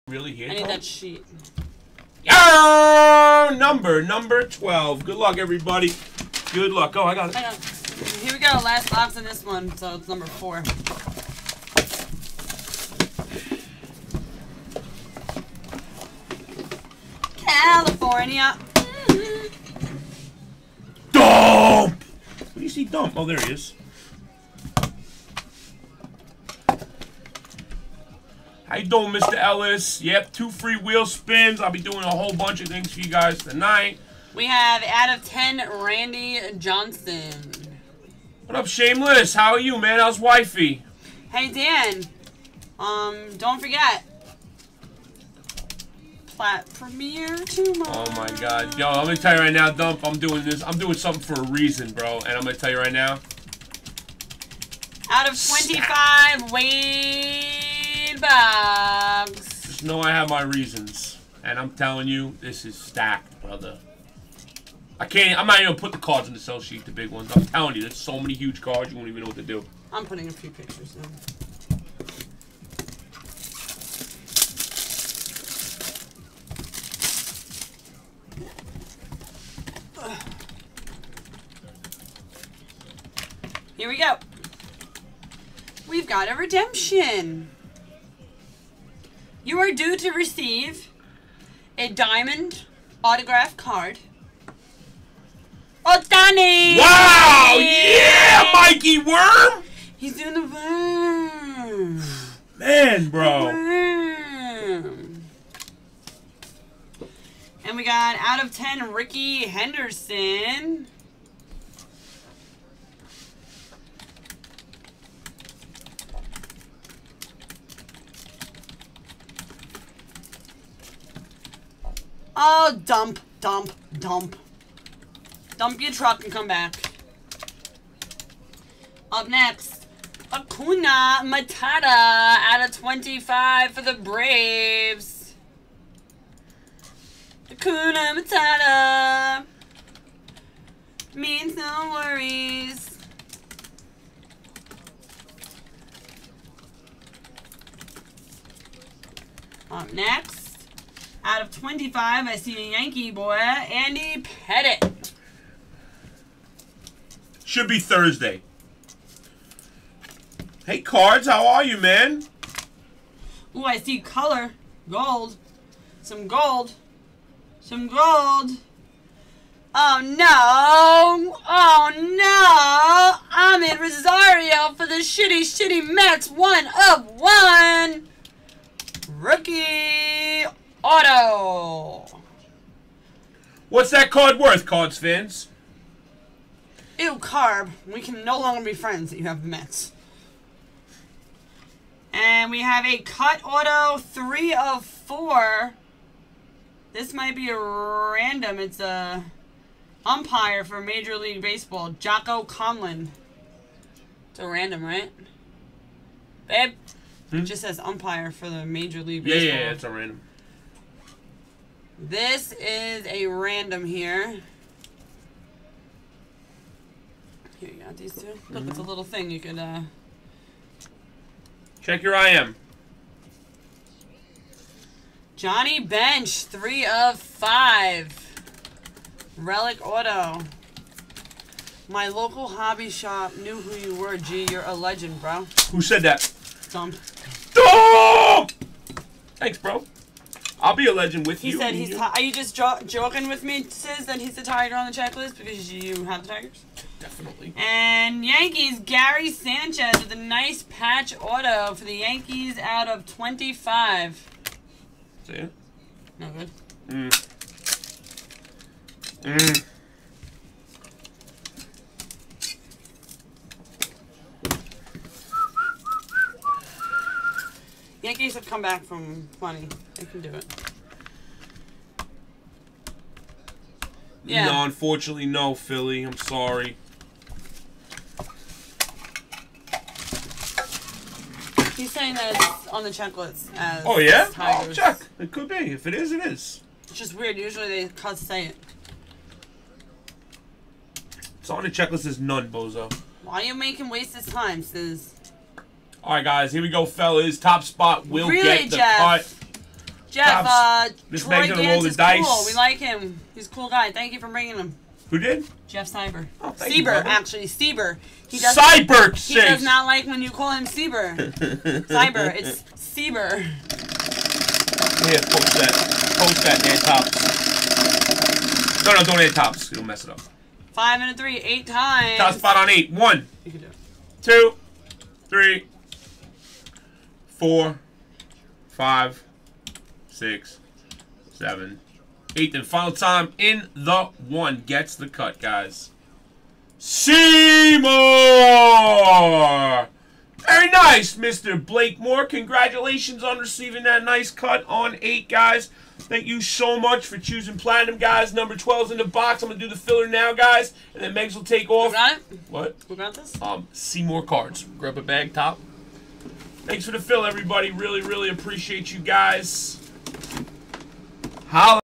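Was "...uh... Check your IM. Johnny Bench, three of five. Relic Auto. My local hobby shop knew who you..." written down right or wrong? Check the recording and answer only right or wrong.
right.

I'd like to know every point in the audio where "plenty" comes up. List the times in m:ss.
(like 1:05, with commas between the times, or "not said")
4:29.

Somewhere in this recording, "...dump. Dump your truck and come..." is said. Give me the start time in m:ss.
2:03.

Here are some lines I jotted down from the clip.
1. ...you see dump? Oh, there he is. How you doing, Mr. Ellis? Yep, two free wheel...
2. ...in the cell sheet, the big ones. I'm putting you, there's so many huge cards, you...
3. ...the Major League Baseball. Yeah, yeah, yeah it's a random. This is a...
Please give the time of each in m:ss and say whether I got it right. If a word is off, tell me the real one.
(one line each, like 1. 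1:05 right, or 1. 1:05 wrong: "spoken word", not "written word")
1. 0:22 right
2. 1:06 wrong: "telling", not "putting"
3. 3:28 right.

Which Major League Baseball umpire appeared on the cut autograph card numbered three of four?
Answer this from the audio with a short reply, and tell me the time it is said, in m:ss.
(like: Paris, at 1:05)
Jocko Conlan, at 3:21.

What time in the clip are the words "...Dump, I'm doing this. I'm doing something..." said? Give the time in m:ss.
0:49.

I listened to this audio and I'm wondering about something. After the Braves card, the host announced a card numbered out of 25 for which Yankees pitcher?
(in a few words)
Andy Pettitte.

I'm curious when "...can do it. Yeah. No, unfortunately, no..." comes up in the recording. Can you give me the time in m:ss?
4:30.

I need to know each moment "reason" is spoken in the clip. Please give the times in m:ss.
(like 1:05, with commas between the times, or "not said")
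0:51, 1:00.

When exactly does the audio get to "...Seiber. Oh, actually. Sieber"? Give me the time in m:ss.
5:05.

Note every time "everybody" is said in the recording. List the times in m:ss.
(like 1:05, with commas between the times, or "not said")
0:05, 5:57.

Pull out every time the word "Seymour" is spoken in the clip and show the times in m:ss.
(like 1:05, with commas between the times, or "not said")
5:36, 5:53.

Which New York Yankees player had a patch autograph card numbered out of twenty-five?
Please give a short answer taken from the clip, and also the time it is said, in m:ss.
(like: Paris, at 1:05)
Gary Sanchez, at 4:08.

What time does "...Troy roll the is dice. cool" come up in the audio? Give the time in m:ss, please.
5:01.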